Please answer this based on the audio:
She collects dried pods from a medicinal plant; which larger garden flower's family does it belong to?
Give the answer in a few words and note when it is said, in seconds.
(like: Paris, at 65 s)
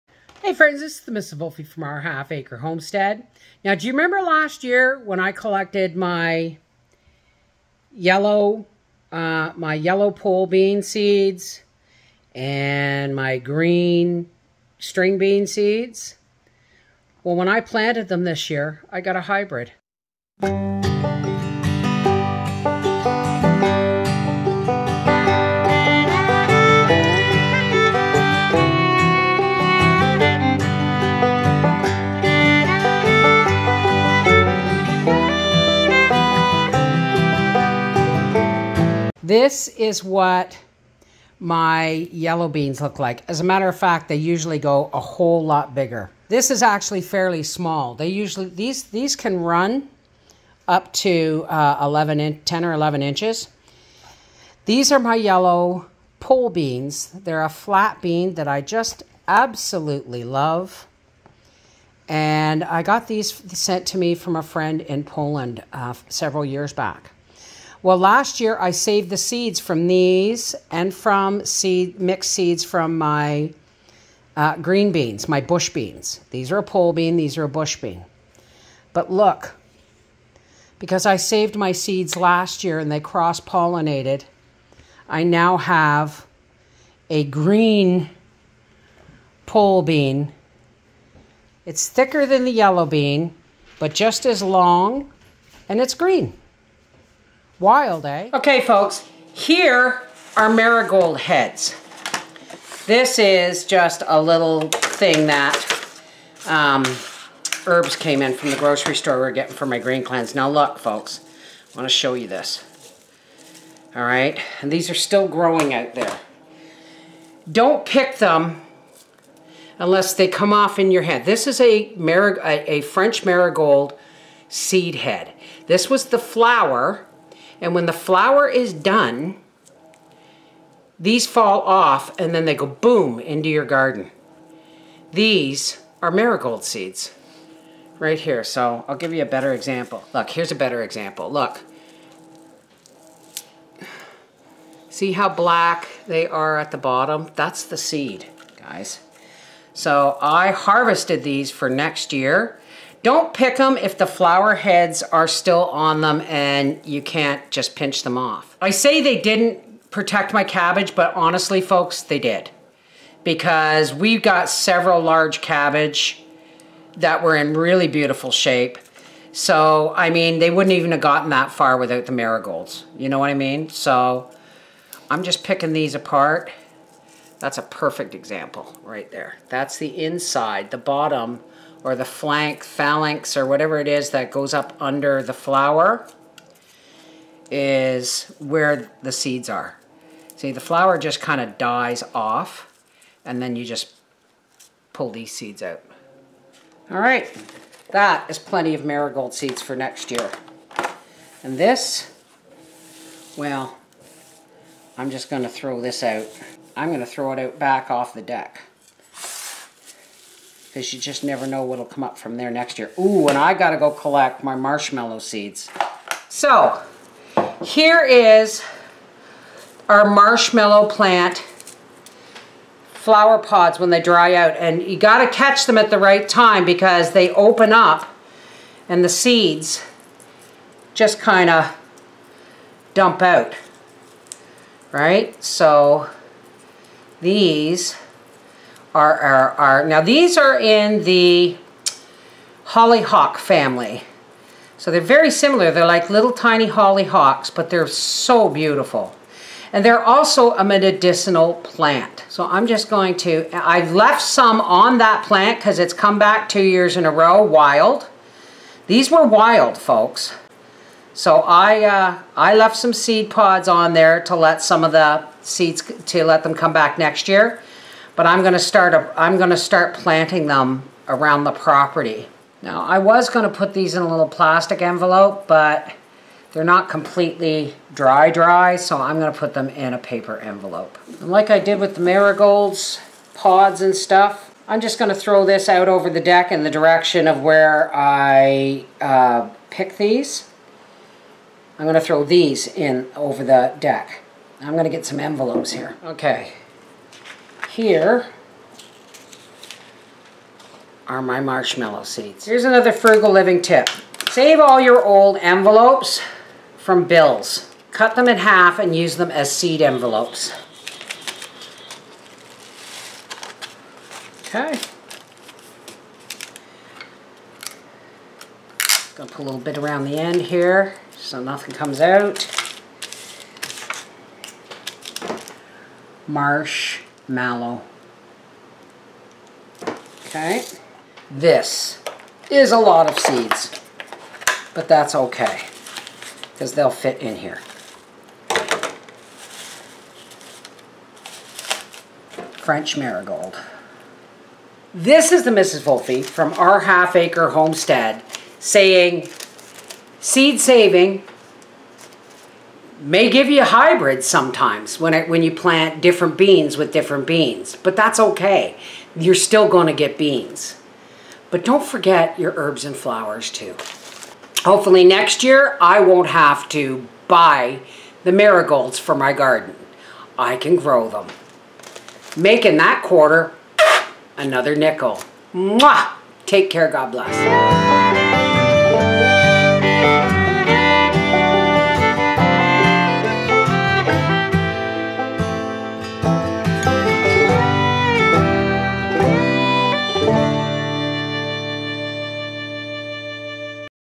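hollyhock, at 242 s.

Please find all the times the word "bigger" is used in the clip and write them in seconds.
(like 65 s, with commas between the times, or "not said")
45 s.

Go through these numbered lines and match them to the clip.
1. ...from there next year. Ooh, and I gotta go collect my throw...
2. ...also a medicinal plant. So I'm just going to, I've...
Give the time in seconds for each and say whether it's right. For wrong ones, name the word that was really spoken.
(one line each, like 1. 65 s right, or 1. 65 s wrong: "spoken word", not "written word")
1. 212 s wrong: "marshmallow", not "throw"
2. 250 s right.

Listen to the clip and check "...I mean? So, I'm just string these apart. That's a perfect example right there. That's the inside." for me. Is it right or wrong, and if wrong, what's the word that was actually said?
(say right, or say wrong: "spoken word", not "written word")
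wrong: "picking", not "string".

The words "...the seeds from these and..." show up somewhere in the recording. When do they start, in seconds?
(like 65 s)
69 s.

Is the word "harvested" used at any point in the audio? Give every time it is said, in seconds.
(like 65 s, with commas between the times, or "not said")
150 s.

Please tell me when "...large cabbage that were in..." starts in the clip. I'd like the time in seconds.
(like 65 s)
165 s.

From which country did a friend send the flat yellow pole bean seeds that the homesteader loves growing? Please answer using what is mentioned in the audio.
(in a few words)
Poland.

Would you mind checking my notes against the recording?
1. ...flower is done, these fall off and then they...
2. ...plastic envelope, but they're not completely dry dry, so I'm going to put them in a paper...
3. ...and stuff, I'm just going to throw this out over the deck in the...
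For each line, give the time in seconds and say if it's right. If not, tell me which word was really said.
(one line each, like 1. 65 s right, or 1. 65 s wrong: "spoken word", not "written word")
1. 127 s right
2. 274 s right
3. 283 s right.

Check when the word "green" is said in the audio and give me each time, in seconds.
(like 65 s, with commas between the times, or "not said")
13 s, 74 s, 87 s, 95 s, 109 s.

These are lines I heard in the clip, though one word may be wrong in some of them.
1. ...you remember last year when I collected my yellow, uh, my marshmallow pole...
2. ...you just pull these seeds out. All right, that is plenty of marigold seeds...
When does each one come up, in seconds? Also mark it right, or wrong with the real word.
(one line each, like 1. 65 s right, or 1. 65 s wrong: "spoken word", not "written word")
1. 3 s wrong: "yellow", not "marshmallow"
2. 193 s right.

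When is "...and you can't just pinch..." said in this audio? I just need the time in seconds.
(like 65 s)
156 s.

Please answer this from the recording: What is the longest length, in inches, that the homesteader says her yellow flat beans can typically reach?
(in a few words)
11 inches.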